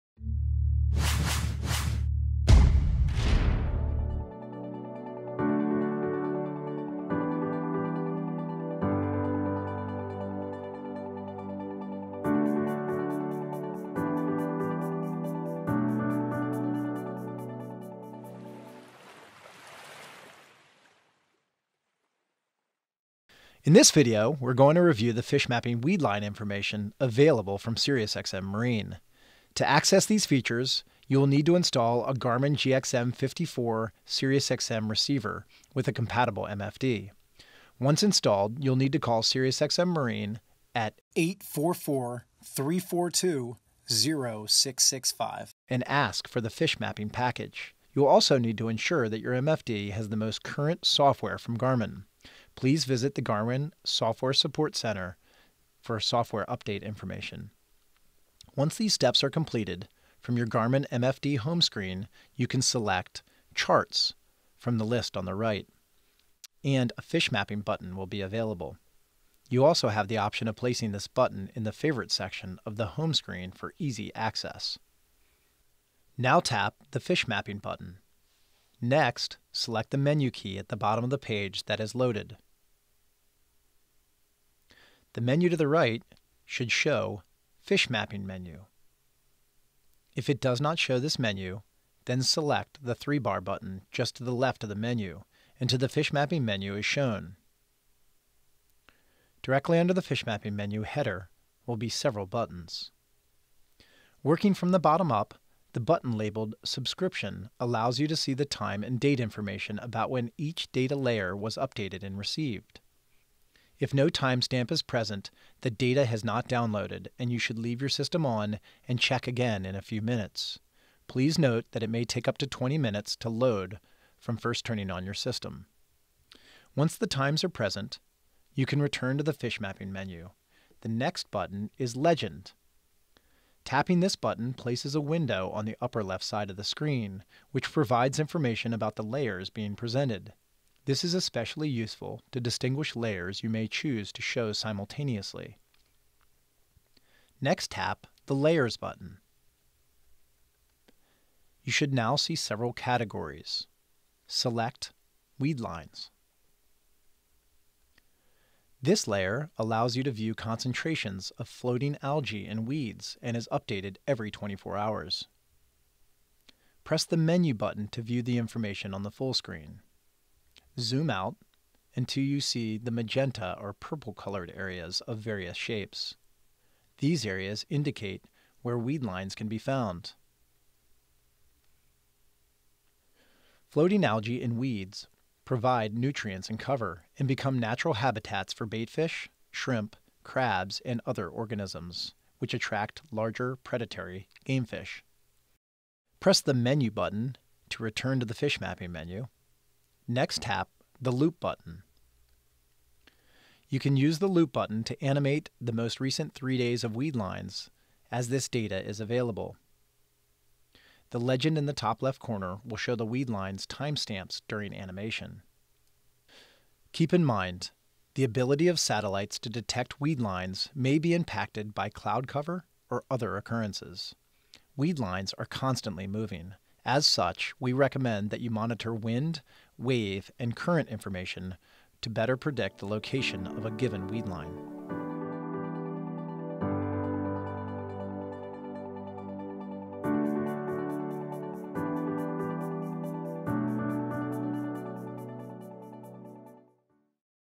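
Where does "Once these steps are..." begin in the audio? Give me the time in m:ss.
0:58.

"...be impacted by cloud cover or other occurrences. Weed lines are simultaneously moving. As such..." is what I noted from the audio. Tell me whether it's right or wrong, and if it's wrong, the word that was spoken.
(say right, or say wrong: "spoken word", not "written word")
wrong: "constantly", not "simultaneously".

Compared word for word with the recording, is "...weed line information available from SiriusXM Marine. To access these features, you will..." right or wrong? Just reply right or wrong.
right.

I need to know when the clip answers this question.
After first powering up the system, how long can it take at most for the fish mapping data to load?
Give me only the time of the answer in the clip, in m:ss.
2:02.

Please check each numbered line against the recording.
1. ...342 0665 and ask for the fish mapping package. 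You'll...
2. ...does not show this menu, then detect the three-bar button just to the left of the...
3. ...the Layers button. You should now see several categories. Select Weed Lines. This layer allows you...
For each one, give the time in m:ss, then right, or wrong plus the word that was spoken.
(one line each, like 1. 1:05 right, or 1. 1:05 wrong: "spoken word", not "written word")
1. 0:42 right
2. 1:30 wrong: "select", not "detect"
3. 2:28 right.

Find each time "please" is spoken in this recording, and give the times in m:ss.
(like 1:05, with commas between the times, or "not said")
0:52, 2:01.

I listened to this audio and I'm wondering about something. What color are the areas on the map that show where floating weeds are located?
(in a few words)
Magenta or purple.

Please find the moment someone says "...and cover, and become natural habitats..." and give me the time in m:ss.
3:06.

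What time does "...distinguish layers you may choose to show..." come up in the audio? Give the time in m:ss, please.
2:22.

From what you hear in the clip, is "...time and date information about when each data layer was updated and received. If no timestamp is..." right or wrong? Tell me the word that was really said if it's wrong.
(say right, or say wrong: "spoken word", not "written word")
right.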